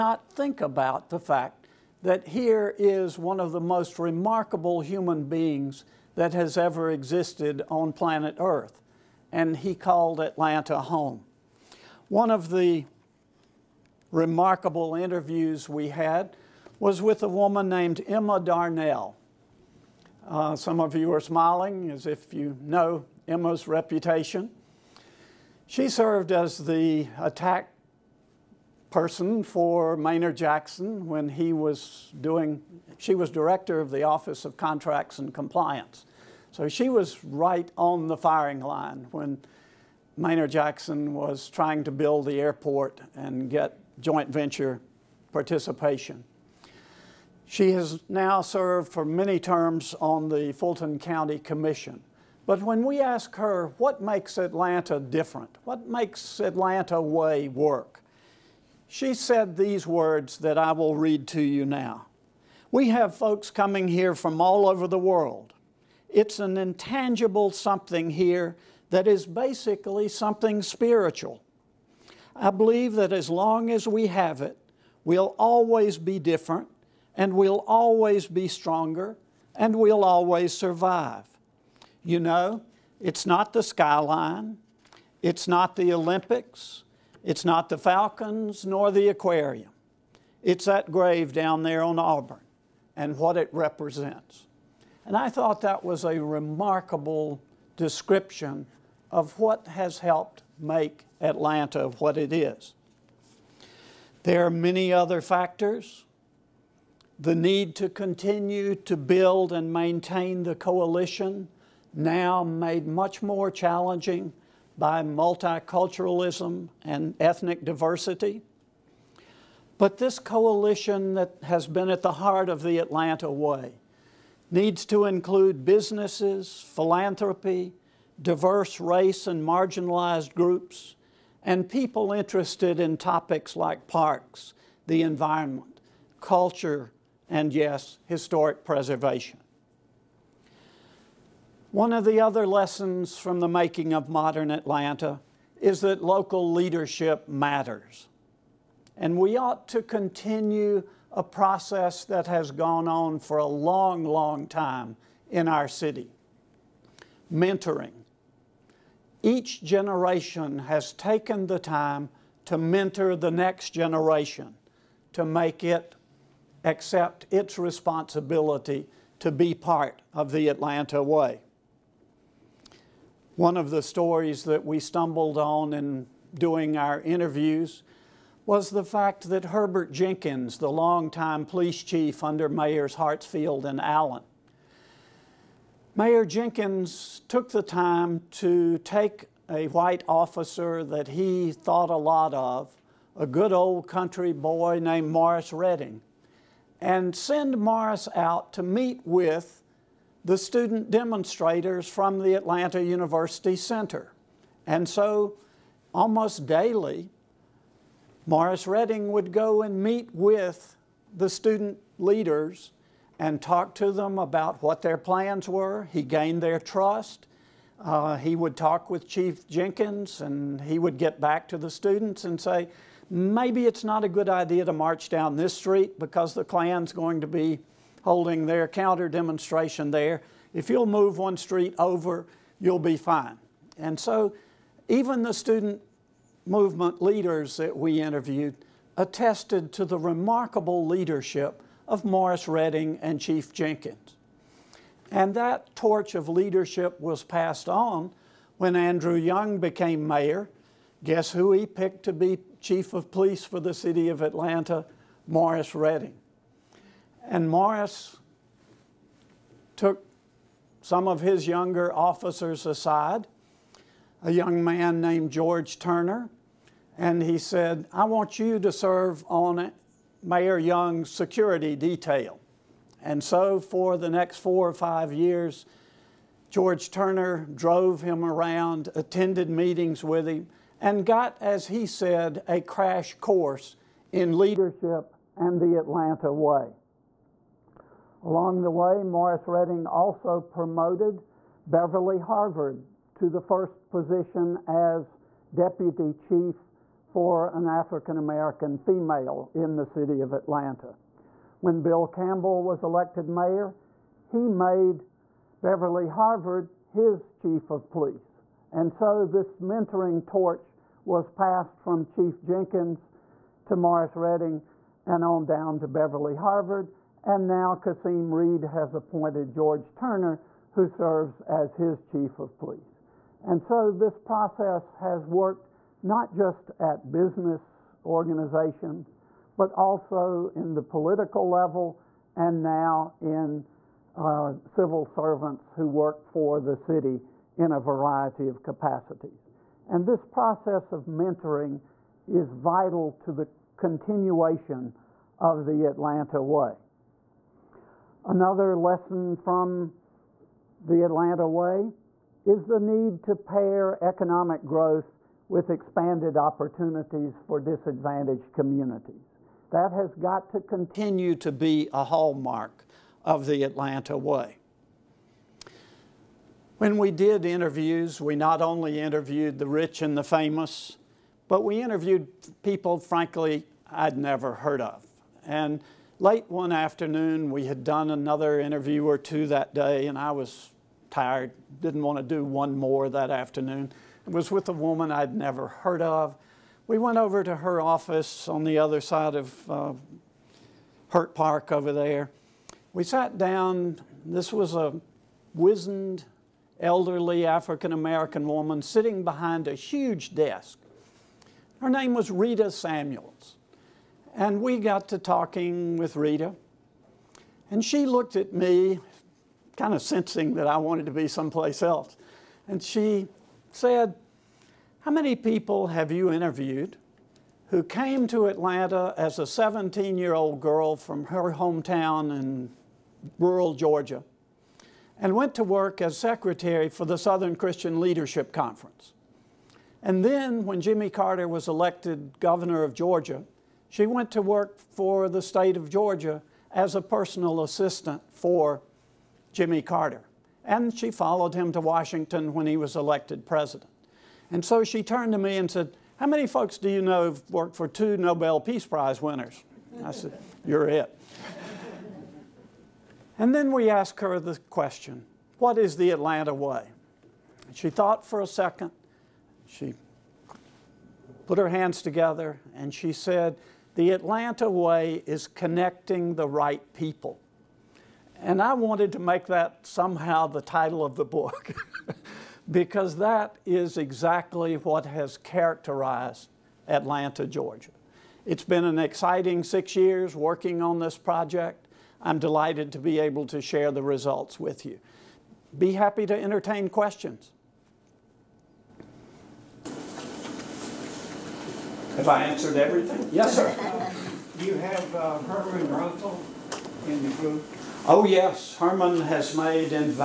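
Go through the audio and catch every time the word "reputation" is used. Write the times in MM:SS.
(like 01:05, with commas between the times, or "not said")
00:23.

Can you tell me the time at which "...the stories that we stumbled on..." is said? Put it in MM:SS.
02:53.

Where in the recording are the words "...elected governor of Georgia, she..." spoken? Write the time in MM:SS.
07:11.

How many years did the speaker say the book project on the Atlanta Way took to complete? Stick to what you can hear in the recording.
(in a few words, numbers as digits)
6.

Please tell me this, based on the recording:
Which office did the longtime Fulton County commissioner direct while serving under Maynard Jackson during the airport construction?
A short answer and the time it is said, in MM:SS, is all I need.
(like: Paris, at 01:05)
Office of Contracts and Compliance, at 00:34.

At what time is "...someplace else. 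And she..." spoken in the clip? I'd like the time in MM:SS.
06:51.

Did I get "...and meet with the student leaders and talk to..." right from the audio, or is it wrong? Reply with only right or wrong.
right.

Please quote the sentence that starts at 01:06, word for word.
It's an intangible something here that is basically something spiritual.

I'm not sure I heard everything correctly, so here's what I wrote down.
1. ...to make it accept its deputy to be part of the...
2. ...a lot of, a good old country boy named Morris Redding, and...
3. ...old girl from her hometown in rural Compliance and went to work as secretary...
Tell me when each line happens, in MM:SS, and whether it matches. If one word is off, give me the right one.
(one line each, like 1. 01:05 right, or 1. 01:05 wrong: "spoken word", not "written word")
1. 02:45 wrong: "responsibility", not "deputy"
2. 03:11 right
3. 07:00 wrong: "Georgia", not "Compliance".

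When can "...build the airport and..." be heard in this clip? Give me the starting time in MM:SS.
00:41.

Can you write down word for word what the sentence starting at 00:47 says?
She has now served for many terms on the Fulton County Commission.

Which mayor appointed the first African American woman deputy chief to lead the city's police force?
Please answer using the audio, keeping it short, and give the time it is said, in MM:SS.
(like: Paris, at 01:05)
Bill Campbell, at 05:01.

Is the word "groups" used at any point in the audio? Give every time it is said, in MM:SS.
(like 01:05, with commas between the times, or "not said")
02:10, 08:17.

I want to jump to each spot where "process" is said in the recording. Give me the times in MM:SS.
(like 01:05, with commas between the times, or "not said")
02:31, 05:24, 05:40.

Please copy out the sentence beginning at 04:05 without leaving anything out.
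And that torch of leadership was passed on when Andrew Young became mayor.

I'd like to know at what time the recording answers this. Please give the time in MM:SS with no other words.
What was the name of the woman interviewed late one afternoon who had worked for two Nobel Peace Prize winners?
06:42.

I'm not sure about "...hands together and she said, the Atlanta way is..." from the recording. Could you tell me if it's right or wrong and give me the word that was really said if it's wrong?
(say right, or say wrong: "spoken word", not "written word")
right.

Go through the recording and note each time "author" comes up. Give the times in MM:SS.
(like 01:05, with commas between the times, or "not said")
not said.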